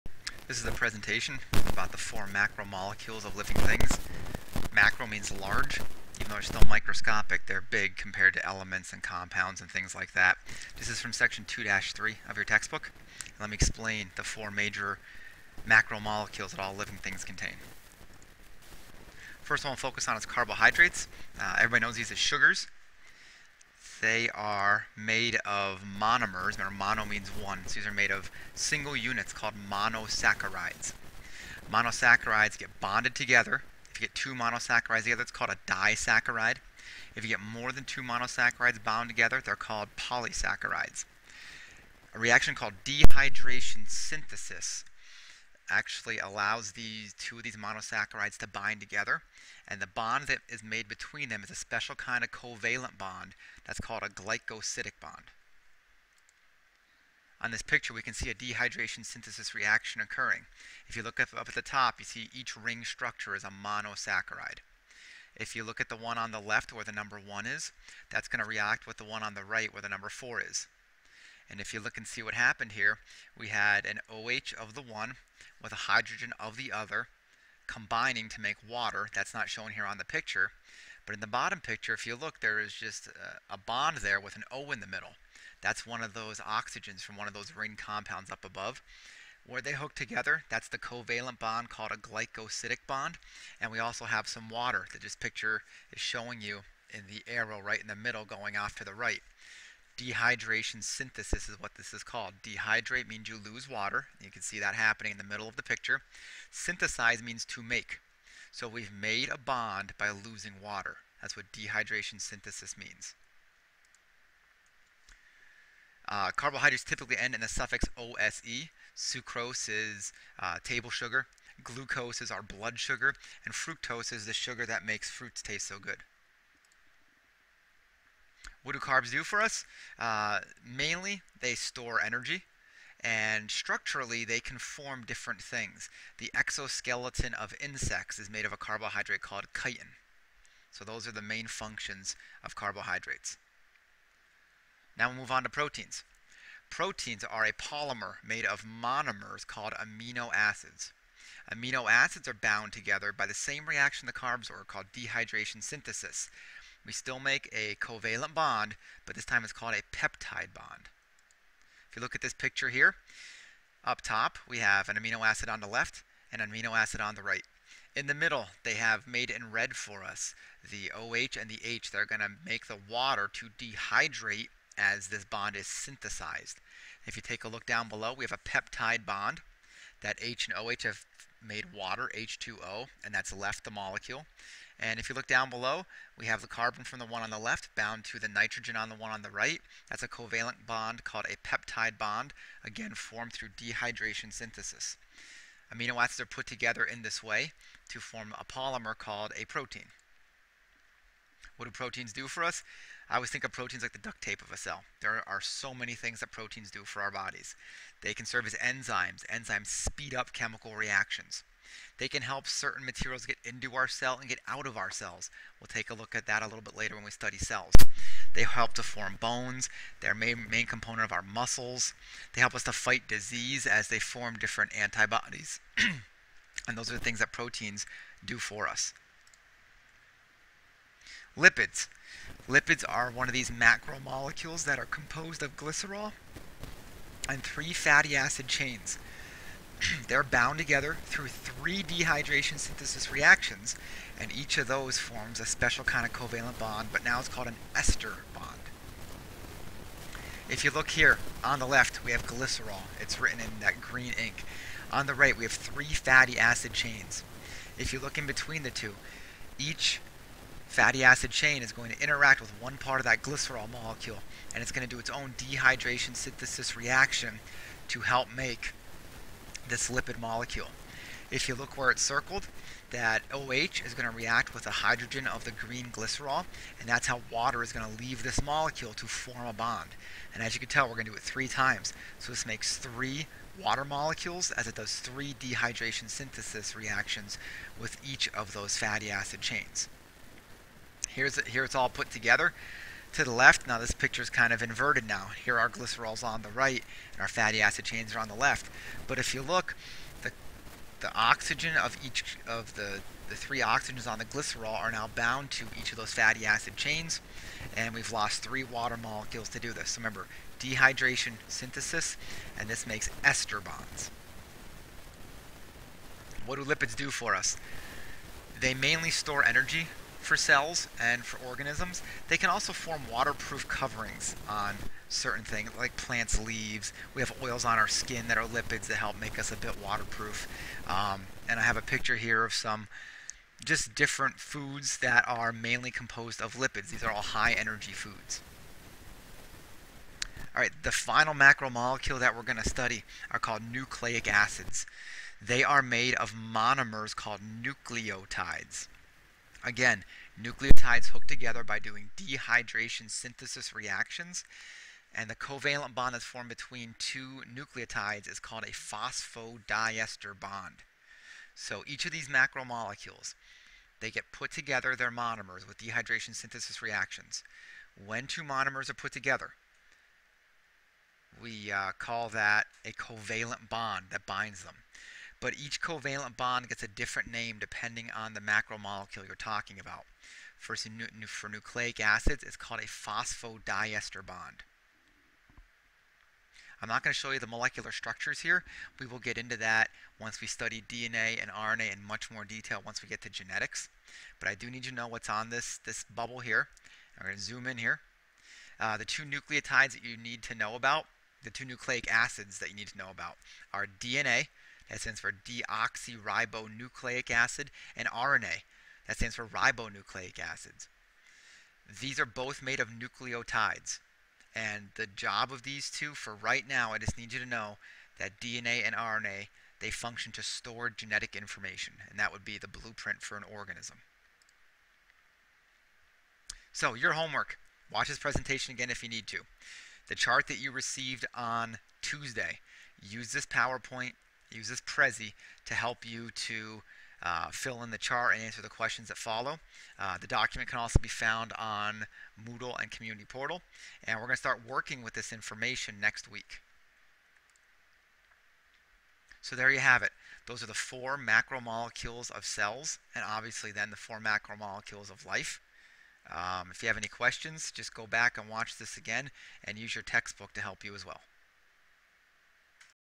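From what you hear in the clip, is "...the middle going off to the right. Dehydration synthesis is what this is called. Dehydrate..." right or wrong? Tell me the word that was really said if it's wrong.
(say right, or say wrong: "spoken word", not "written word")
right.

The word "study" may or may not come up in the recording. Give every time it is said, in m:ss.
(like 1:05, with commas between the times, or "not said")
3:37, 5:42, 6:30.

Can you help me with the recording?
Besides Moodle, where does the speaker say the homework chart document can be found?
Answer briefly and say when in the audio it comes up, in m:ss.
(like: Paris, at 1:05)
Community Portal, at 7:22.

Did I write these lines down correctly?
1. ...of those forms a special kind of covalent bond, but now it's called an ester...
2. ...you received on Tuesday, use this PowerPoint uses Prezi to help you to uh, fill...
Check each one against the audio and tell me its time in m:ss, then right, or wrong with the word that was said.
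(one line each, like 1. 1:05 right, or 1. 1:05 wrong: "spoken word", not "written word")
1. 4:04 right
2. 7:10 right.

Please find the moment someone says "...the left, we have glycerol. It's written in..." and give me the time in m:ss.
4:11.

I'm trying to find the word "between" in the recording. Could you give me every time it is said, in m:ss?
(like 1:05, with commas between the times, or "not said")
0:50, 4:18, 5:56.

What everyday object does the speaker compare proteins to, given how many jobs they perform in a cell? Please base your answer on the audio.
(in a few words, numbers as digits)
duct tape.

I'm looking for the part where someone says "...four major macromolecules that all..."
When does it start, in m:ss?
0:14.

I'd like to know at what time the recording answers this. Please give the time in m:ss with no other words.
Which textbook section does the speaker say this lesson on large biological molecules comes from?
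0:11.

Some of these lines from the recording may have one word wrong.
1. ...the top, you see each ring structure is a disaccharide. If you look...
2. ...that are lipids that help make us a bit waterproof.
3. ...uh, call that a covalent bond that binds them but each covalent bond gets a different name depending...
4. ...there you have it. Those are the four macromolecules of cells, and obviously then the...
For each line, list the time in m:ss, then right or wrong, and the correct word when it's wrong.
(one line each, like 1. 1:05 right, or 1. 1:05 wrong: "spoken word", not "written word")
1. 1:01 wrong: "monosaccharide", not "disaccharide"
2. 5:28 right
3. 6:11 right
4. 7:29 right.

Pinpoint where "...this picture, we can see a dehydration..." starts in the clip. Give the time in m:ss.
0:57.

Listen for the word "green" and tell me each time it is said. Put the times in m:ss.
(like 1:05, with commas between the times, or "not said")
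4:13, 4:35.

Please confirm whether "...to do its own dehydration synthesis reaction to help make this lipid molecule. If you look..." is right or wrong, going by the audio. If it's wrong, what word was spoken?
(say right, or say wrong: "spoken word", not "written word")
right.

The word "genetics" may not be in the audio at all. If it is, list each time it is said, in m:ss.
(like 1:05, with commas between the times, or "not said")
6:33, 7:00.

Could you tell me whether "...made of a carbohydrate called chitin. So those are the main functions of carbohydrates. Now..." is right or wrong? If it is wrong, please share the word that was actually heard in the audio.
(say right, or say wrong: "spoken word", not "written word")
right.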